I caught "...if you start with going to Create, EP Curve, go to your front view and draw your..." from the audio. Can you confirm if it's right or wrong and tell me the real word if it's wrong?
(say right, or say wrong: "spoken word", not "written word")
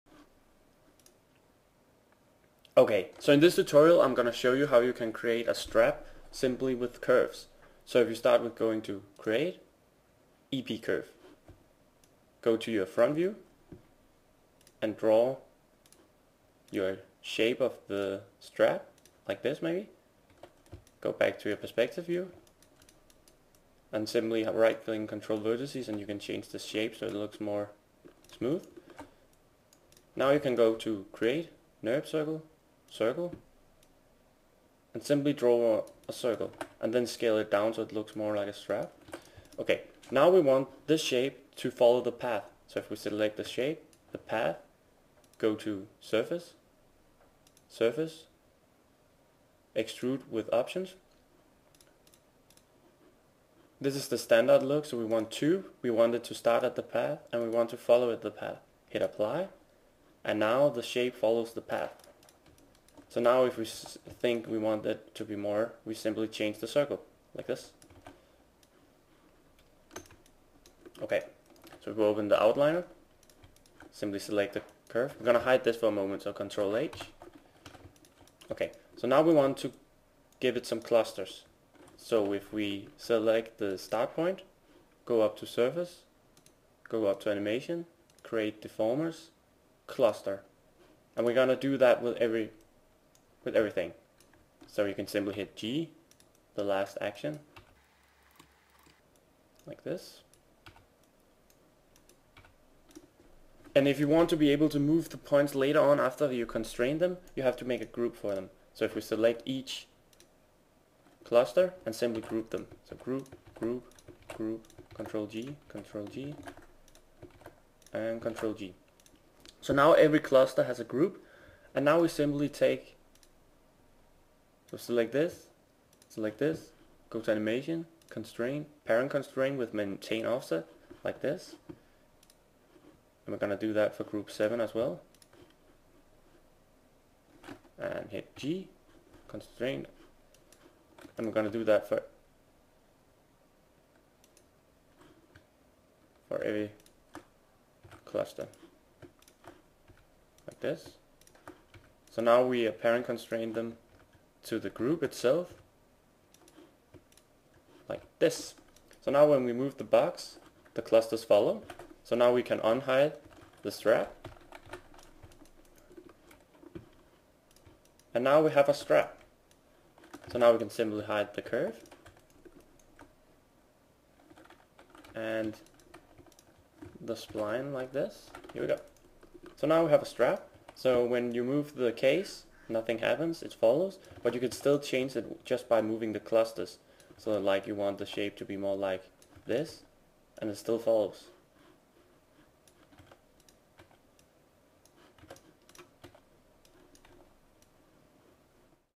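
right.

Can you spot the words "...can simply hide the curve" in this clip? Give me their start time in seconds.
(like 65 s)
170 s.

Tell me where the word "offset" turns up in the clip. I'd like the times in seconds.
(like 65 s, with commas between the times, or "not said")
130 s.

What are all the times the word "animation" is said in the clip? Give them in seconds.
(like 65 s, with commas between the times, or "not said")
87 s, 127 s.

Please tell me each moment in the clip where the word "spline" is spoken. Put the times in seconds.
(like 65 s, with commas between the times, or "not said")
177 s.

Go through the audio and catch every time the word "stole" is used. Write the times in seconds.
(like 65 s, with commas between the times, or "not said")
not said.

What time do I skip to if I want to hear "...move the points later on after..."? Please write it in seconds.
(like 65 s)
104 s.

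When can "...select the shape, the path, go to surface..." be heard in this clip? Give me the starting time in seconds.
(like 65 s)
42 s.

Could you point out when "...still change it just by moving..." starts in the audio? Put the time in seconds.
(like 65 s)
184 s.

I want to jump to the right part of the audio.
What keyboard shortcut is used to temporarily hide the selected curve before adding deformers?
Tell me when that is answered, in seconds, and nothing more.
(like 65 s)
76 s.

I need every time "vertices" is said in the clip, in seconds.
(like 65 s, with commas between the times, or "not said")
25 s.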